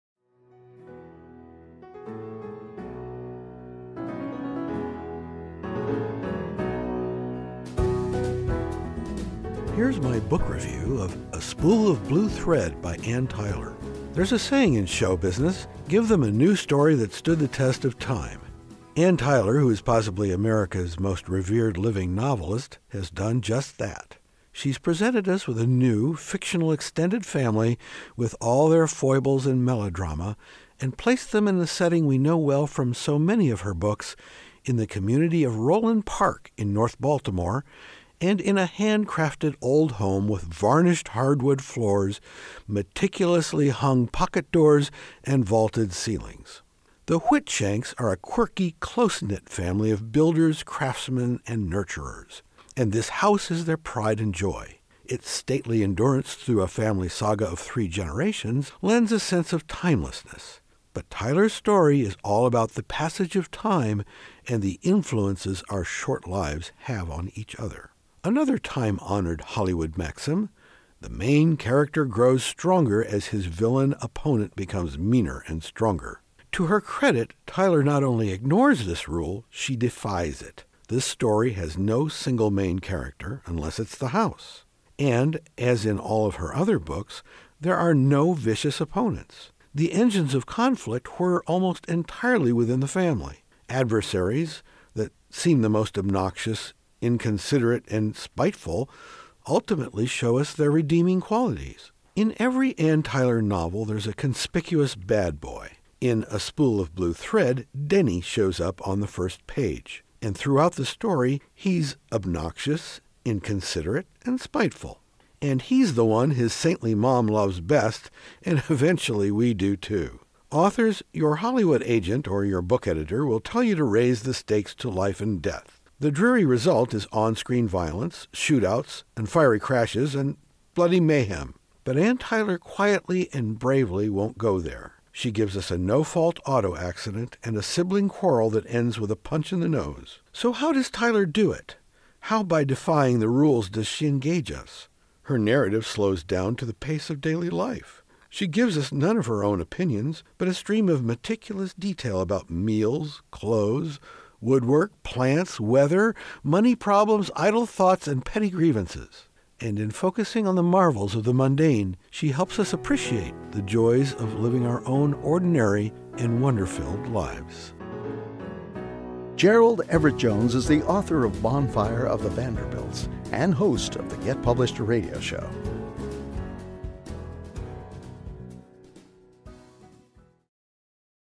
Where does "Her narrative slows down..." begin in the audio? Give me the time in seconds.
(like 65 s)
145 s.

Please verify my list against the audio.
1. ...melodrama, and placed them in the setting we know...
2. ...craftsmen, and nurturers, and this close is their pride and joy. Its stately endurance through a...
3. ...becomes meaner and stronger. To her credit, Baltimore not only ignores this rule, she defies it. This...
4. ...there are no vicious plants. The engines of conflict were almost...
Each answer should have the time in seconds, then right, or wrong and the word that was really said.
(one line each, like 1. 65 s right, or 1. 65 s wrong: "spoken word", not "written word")
1. 29 s right
2. 50 s wrong: "house", not "close"
3. 74 s wrong: "Tyler", not "Baltimore"
4. 87 s wrong: "opponents", not "plants".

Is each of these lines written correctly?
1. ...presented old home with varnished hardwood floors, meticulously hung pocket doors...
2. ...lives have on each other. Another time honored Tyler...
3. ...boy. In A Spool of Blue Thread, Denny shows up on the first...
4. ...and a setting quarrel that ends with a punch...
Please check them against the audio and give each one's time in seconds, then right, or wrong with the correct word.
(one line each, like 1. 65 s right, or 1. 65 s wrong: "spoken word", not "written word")
1. 38 s wrong: "handcrafted", not "presented"
2. 66 s wrong: "Hollywood", not "Tyler"
3. 105 s right
4. 137 s wrong: "sibling", not "setting".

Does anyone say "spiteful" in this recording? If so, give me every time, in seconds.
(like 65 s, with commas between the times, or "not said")
98 s, 114 s.